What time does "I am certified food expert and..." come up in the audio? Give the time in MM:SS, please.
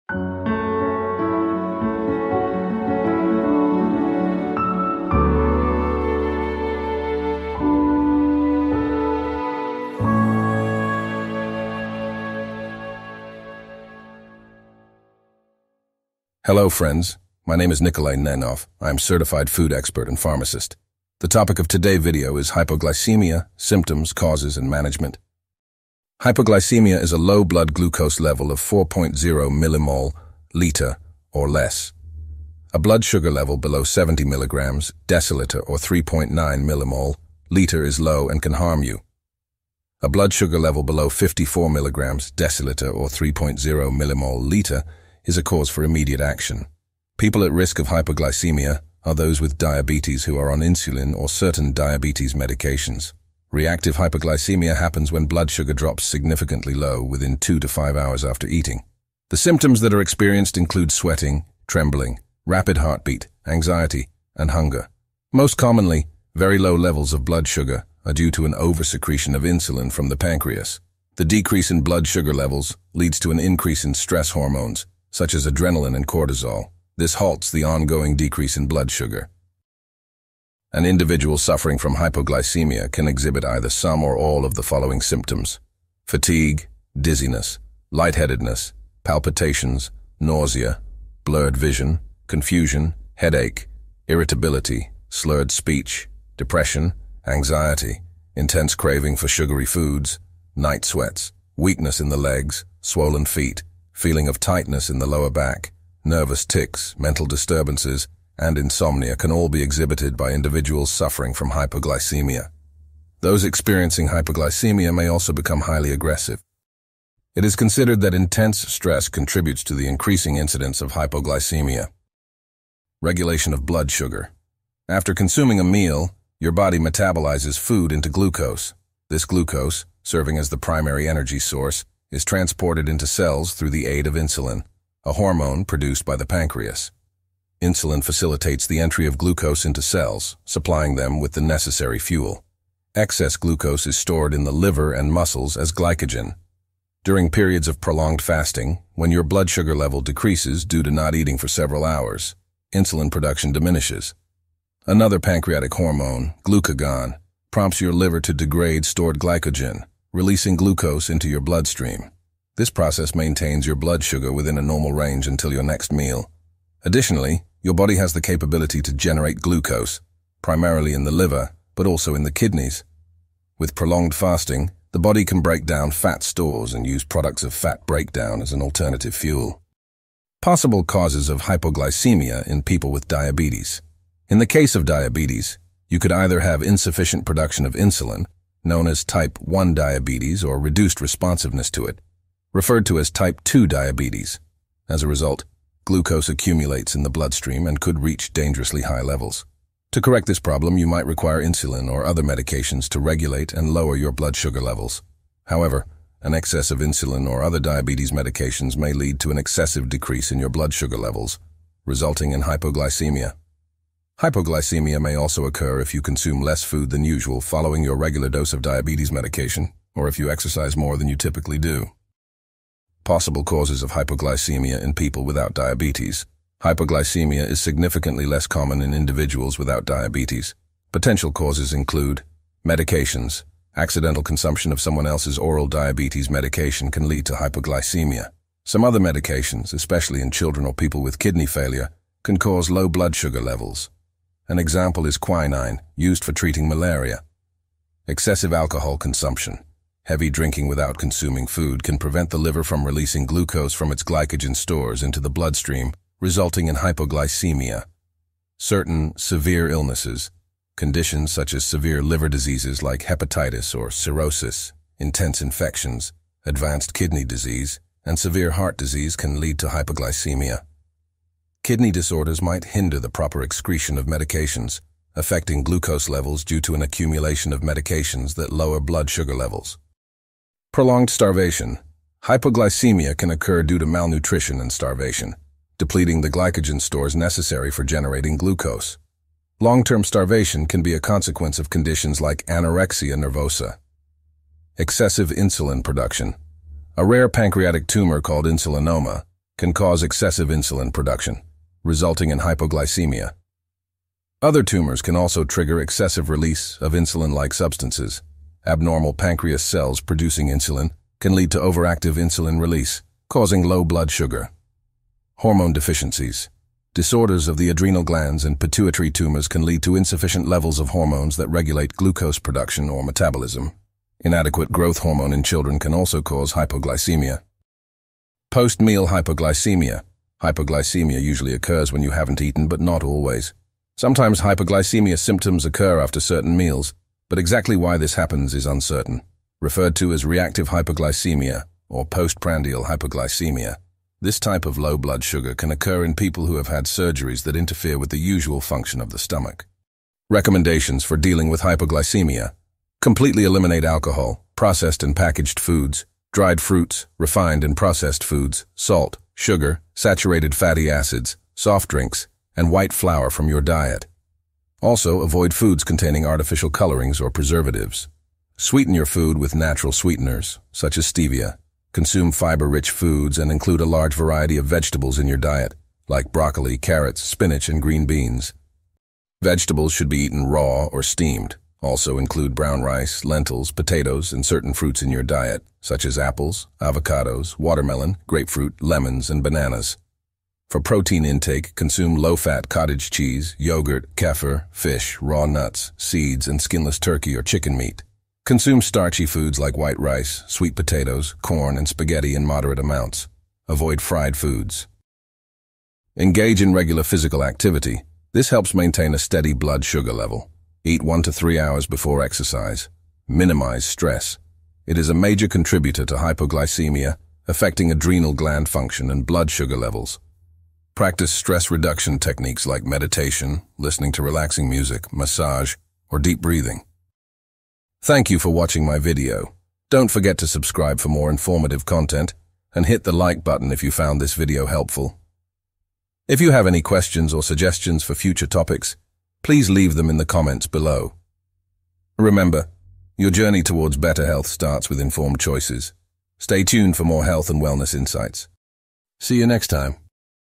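00:18.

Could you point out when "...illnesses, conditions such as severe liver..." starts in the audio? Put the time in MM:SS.
04:19.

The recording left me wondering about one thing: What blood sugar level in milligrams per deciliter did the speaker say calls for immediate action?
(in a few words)
54 mg/dL.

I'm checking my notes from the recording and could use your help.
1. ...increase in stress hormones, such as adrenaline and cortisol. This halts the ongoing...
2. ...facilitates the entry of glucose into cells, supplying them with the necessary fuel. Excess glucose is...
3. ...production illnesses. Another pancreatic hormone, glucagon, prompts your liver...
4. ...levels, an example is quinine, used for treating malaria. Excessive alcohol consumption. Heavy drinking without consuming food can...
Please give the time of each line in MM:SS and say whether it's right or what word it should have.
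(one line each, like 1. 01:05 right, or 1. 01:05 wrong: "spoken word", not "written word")
1. 01:13 right
2. 02:18 right
3. 02:33 wrong: "diminishes", not "illnesses"
4. 04:03 right.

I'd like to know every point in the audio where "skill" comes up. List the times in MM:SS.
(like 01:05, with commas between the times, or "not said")
not said.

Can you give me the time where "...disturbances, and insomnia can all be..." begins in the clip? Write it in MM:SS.
01:47.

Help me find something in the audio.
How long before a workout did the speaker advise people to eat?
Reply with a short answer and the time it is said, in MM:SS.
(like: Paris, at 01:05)
1 to 3 hours, at 06:51.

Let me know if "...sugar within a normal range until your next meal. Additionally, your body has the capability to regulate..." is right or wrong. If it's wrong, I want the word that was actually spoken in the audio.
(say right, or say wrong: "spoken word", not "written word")
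wrong: "generate", not "regulate".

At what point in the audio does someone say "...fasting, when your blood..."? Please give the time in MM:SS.
02:28.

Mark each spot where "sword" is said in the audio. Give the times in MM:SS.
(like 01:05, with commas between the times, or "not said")
not said.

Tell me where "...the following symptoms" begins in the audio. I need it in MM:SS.
01:24.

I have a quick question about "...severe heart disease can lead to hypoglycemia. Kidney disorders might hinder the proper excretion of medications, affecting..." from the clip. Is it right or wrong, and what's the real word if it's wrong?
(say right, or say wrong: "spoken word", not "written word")
right.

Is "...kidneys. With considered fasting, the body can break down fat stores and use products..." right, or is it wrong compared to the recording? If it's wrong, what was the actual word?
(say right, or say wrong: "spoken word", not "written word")
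wrong: "prolonged", not "considered".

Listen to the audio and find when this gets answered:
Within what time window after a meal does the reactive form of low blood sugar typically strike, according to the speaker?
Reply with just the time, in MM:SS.
00:57.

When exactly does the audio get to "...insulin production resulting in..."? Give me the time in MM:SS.
05:00.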